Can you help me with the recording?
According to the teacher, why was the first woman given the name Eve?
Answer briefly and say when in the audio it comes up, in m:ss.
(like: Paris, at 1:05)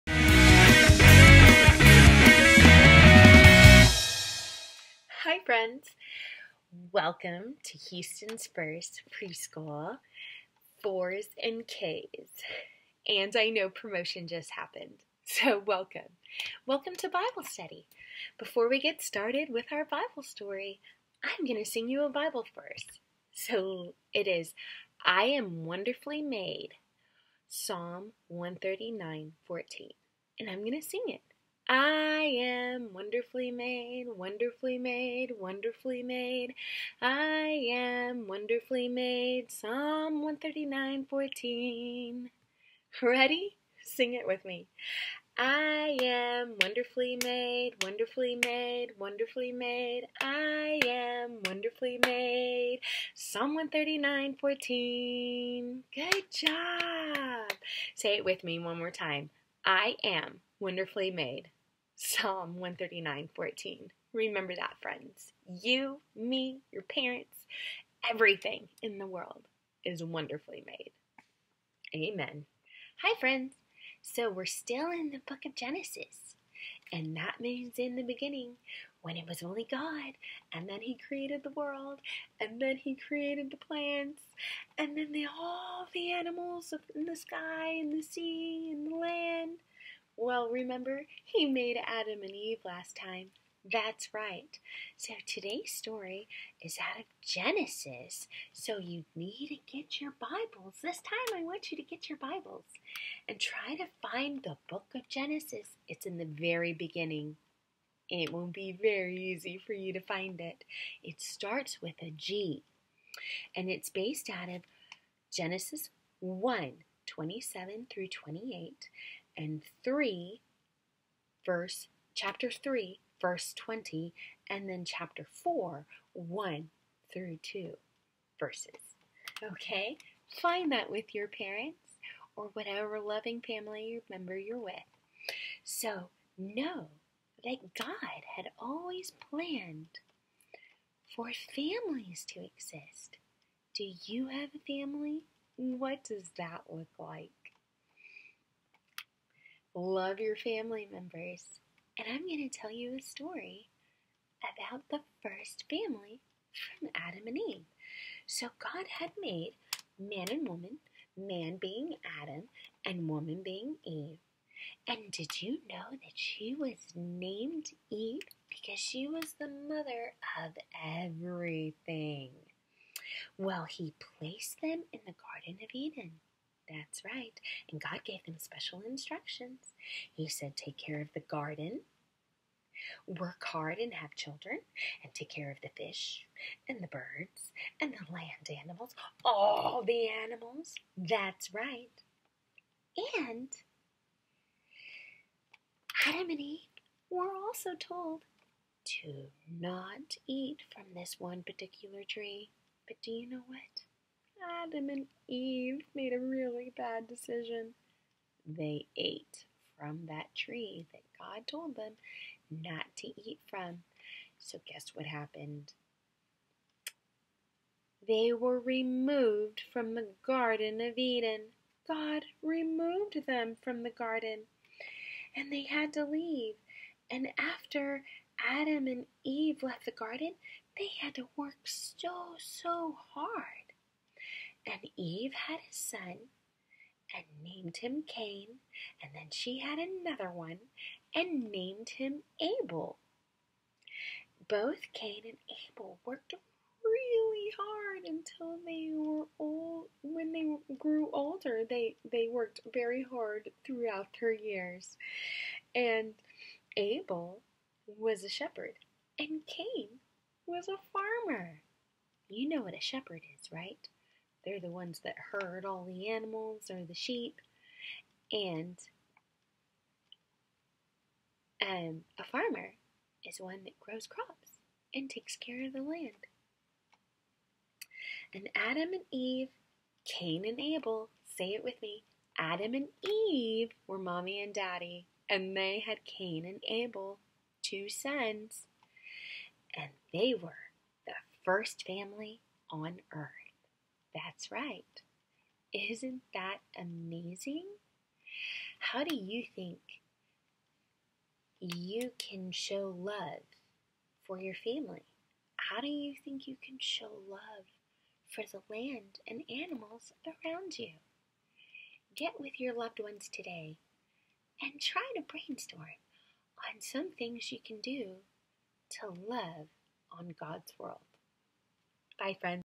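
mother of everything, at 2:49.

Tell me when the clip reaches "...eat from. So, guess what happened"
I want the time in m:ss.
3:33.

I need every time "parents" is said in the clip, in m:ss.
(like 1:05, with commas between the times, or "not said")
1:06, 2:11.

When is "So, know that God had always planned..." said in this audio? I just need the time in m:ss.
2:15.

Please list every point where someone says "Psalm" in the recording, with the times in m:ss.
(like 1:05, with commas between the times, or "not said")
0:27, 0:39, 0:53, 1:01.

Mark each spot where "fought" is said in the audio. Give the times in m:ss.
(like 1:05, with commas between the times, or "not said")
not said.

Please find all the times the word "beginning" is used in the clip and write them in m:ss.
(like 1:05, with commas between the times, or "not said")
1:18, 1:46.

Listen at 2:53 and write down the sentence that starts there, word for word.
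Well, he placed them in the Garden of Eden that's right.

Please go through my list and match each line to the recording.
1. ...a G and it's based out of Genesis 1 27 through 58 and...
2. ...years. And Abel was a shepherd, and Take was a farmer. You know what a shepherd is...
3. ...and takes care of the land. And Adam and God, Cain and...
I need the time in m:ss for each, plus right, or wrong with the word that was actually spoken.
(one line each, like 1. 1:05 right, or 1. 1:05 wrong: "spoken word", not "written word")
1. 1:52 wrong: "28", not "58"
2. 4:14 wrong: "Cain", not "Take"
3. 4:34 wrong: "Eve", not "God".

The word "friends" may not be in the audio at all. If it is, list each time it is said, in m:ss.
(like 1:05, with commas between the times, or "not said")
0:05, 1:04, 1:13, 5:22.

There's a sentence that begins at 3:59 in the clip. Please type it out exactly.
And then she had another one and named him Abel.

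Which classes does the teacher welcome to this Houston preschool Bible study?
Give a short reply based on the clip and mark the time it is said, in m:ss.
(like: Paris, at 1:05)
fours and Ks, at 0:10.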